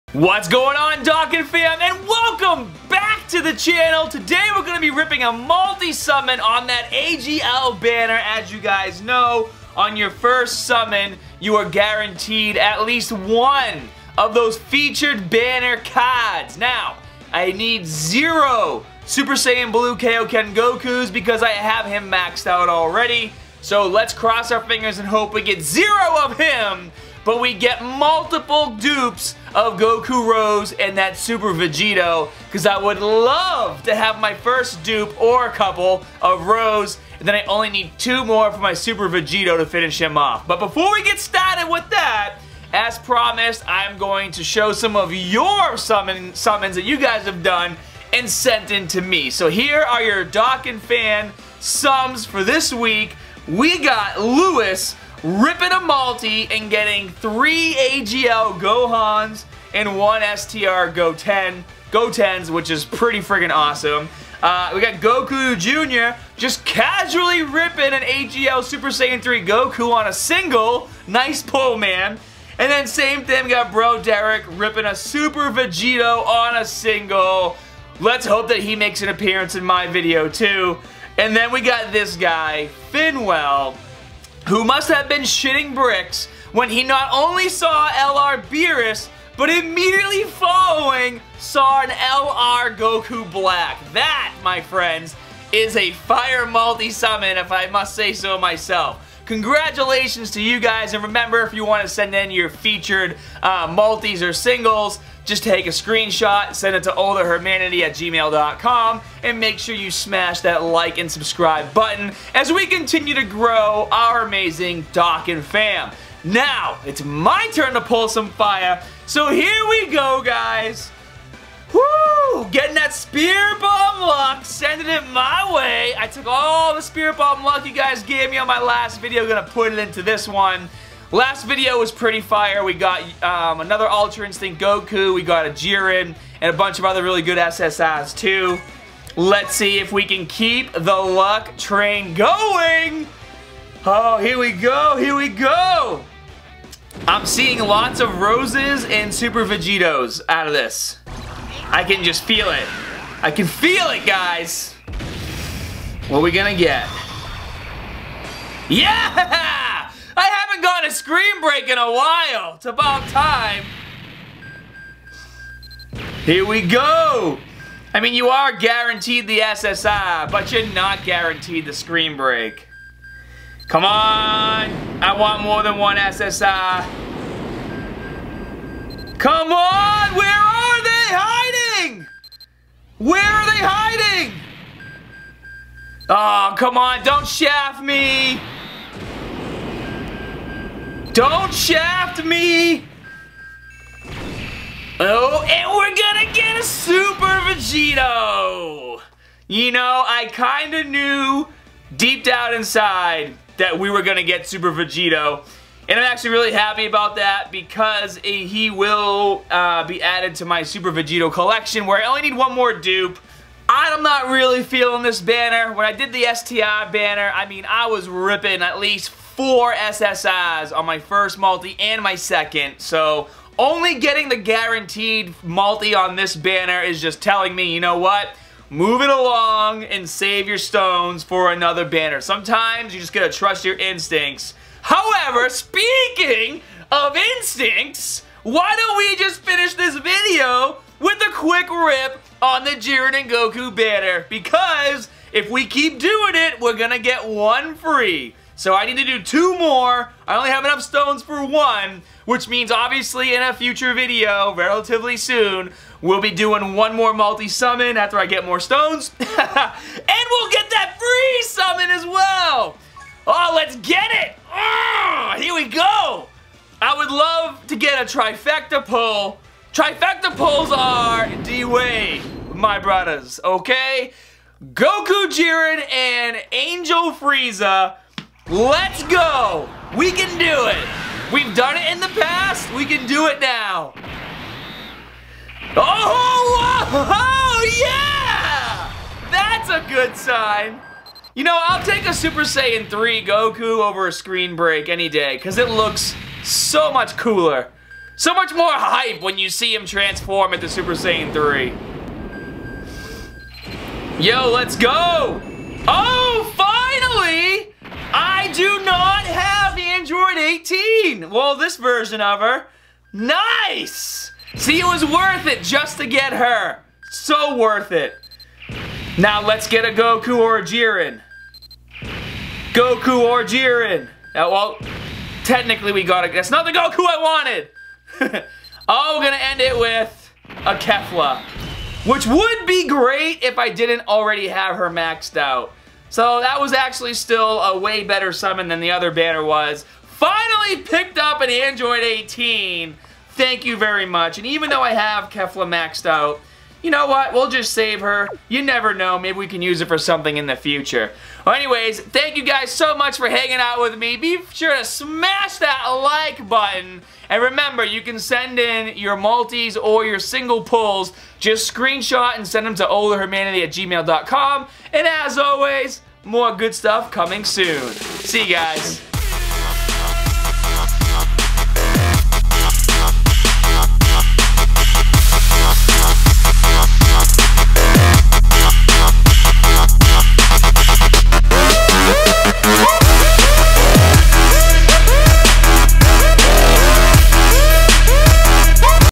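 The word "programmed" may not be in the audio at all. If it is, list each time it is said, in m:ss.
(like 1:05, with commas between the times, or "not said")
not said.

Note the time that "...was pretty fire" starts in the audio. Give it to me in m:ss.
2:11.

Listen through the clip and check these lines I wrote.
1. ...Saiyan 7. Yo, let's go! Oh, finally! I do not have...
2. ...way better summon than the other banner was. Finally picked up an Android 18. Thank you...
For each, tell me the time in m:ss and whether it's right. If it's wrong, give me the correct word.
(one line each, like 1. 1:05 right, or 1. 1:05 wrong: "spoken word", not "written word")
1. 5:00 wrong: "3", not "7"
2. 5:37 right.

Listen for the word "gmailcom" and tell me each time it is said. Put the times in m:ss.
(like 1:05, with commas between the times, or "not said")
1:47, 6:03.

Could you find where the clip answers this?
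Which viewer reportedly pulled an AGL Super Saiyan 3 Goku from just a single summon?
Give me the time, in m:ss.
1:04.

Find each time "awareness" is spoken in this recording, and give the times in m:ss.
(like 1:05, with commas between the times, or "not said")
not said.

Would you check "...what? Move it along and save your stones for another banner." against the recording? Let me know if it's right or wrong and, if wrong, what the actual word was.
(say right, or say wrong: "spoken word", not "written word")
right.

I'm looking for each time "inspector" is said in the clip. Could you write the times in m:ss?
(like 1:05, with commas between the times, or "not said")
not said.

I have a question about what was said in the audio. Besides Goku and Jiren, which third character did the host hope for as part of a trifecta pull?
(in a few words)
Angel Frieza.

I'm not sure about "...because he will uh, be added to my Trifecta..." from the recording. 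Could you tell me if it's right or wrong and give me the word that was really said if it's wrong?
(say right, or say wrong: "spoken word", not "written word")
wrong: "Super", not "Trifecta".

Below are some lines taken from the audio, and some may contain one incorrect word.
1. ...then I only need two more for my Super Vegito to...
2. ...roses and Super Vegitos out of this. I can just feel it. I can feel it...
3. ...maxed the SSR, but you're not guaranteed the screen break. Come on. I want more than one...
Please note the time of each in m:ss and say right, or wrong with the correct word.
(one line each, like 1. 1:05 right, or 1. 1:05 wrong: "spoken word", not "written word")
1. 0:37 right
2. 2:28 right
3. 2:48 wrong: "guaranteed", not "maxed".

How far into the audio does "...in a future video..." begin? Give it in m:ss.
4:13.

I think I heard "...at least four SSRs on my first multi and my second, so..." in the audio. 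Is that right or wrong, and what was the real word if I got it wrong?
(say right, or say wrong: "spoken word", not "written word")
right.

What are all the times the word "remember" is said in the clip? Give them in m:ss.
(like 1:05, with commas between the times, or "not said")
1:41, 5:57.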